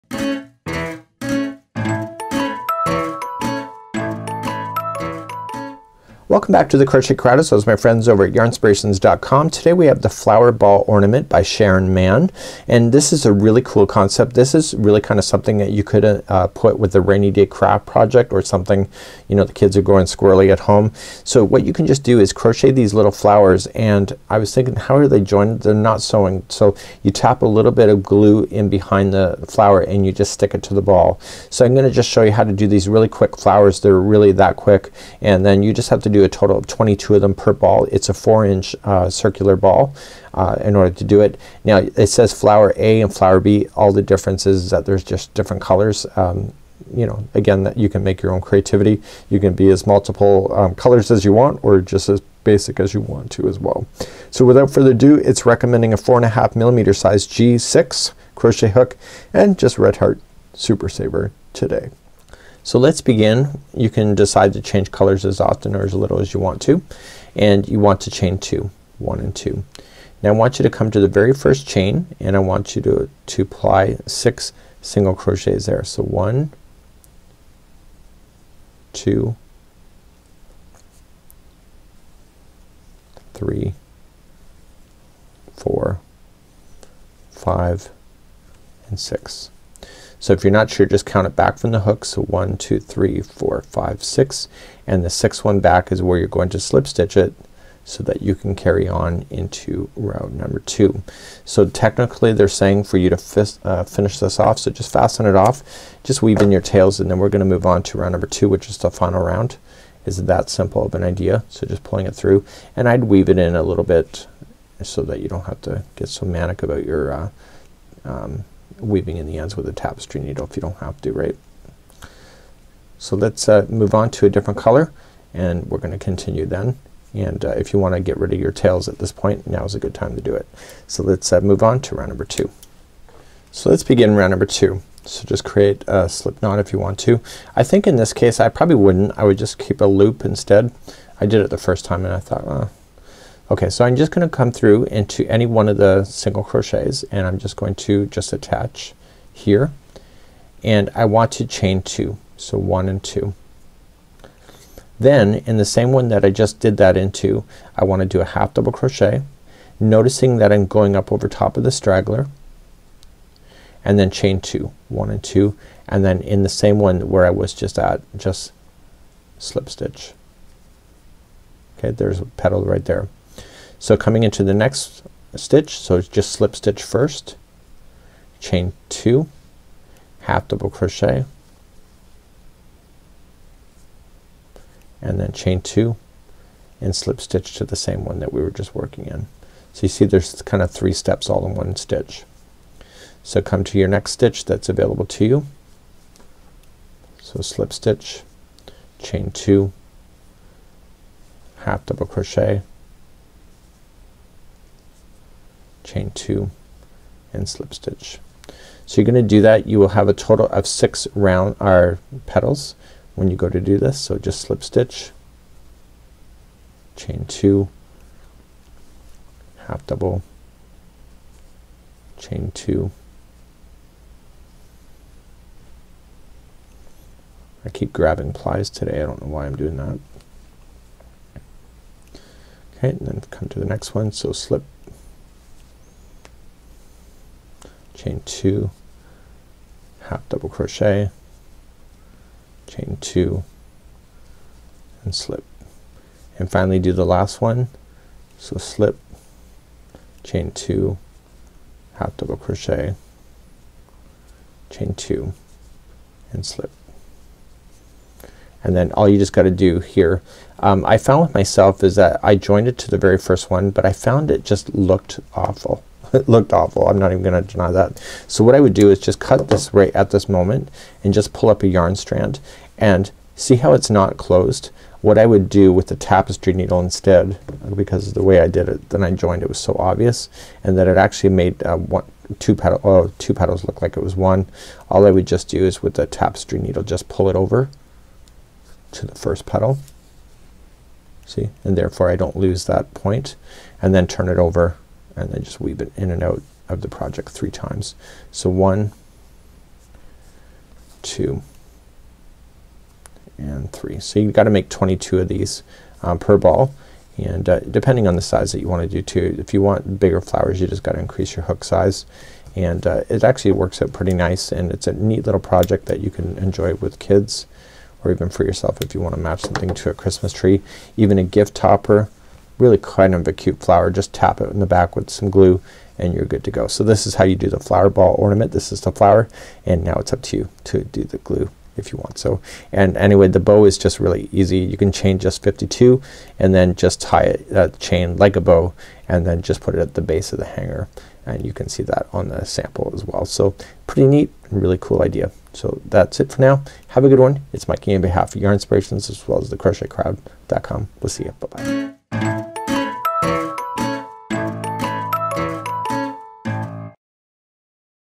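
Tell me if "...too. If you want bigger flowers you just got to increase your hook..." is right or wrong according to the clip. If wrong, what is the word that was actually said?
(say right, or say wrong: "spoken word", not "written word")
right.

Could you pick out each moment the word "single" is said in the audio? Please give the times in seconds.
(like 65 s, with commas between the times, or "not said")
74 s, 146 s.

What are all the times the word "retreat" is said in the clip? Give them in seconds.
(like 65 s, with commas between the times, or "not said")
not said.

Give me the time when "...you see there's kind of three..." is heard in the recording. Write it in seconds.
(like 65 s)
189 s.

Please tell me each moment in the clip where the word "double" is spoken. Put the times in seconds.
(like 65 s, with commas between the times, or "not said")
158 s, 180 s, 201 s, 219 s, 240 s, 252 s.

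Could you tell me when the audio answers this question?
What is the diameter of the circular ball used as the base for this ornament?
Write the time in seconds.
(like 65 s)
38 s.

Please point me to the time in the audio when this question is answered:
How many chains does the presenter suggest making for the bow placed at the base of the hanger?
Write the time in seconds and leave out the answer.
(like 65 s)
335 s.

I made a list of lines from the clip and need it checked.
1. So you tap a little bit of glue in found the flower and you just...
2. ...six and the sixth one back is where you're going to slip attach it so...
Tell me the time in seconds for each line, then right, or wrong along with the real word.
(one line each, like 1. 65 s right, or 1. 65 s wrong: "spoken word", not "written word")
1. 26 s wrong: "behind", not "found"
2. 94 s wrong: "stitch", not "attach".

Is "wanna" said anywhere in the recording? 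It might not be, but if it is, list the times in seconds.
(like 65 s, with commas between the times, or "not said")
127 s, 157 s.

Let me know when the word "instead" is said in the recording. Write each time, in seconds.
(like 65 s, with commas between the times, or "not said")
140 s, 276 s.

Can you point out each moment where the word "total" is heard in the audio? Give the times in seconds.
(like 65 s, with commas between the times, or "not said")
36 s, 210 s.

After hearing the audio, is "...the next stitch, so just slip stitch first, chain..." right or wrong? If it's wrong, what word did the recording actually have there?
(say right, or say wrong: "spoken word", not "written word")
right.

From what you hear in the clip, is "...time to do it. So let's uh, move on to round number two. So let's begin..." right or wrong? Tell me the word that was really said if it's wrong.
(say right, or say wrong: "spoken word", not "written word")
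right.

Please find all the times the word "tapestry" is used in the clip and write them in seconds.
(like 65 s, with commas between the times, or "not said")
119 s, 275 s, 286 s.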